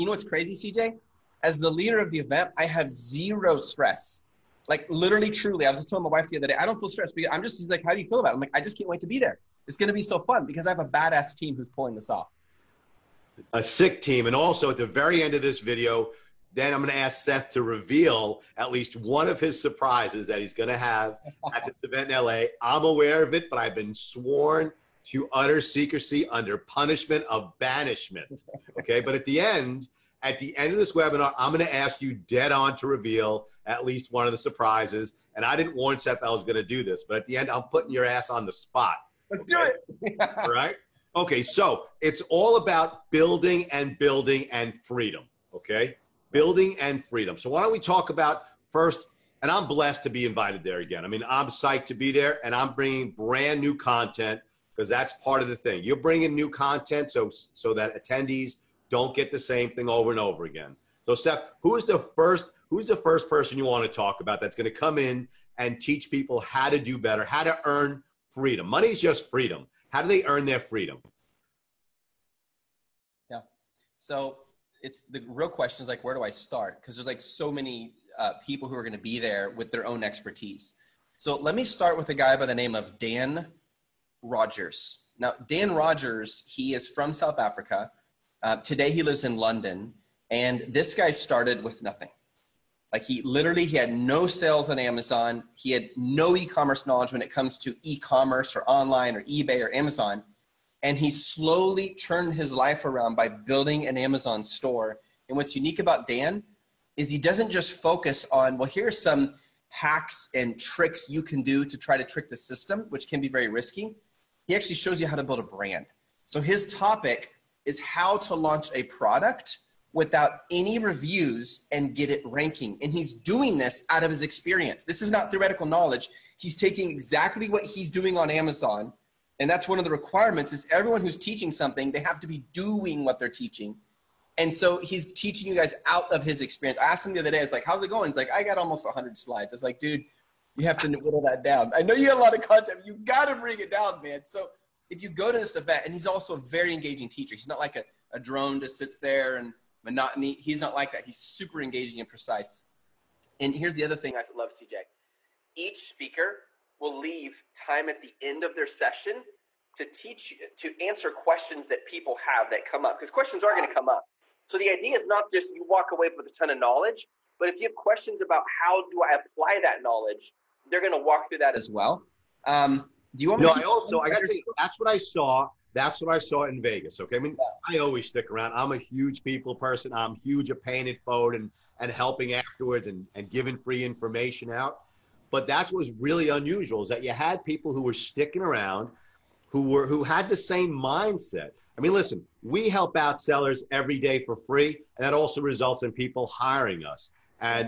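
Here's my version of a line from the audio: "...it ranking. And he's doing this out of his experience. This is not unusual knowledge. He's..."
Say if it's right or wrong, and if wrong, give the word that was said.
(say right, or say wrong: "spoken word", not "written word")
wrong: "theoretical", not "unusual".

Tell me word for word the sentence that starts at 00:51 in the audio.
I mean, I'm psyched to be there, and I'm bringing brand new content because that's part of the thing.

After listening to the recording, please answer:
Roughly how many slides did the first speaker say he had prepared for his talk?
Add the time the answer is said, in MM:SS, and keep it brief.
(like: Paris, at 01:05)
100, at 02:18.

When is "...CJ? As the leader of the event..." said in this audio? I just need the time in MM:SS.
00:00.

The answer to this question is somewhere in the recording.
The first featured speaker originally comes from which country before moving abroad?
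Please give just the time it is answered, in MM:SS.
01:27.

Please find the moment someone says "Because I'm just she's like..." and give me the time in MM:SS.
00:07.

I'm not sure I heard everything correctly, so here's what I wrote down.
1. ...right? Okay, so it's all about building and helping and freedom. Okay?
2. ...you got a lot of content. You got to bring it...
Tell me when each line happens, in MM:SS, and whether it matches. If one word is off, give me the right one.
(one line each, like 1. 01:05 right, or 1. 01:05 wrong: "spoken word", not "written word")
1. 00:40 wrong: "building", not "helping"
2. 02:21 right.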